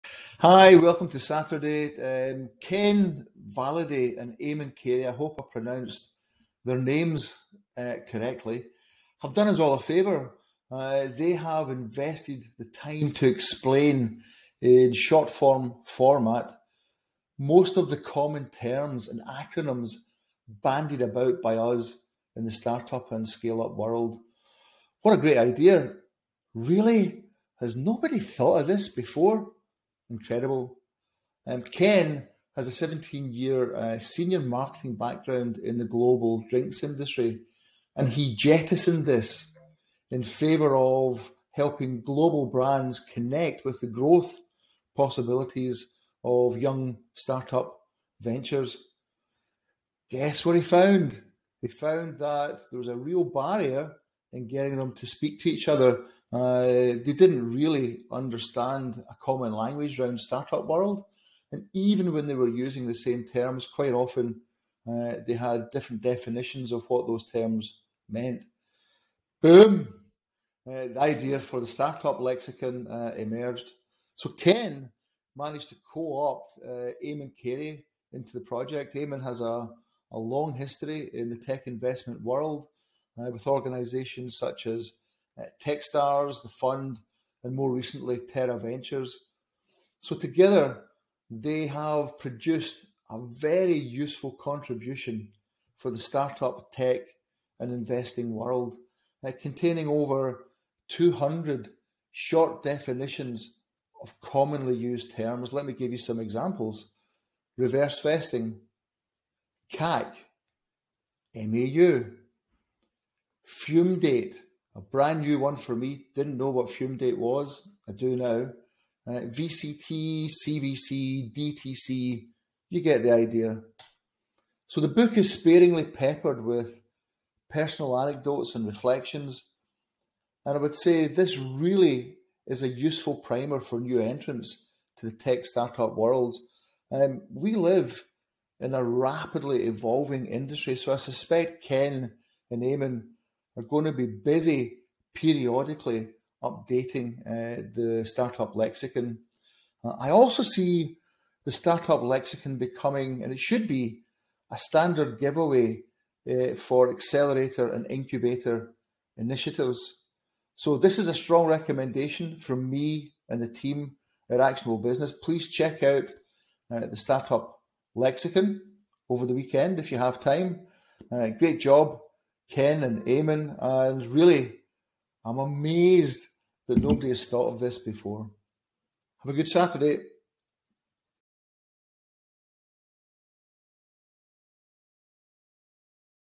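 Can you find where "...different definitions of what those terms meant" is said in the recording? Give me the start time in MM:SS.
01:05.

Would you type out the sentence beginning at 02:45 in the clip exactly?
Please check out uh, the startup lexicon over the weekend if you have time.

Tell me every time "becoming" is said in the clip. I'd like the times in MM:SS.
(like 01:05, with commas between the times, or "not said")
02:32.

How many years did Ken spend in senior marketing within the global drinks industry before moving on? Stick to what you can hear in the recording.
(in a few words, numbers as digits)
17.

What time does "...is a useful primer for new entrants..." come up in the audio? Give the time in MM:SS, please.
02:12.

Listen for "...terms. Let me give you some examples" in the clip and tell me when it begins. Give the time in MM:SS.
01:45.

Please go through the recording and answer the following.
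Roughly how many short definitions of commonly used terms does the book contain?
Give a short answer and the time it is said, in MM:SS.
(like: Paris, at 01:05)
over 200, at 01:39.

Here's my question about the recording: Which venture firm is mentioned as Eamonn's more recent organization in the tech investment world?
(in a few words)
Tera Ventures.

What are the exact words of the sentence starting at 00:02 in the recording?
Um, Ken Validay and Eamonn Carey, I hope I pronounced their names uh, correctly, have done us all a favour.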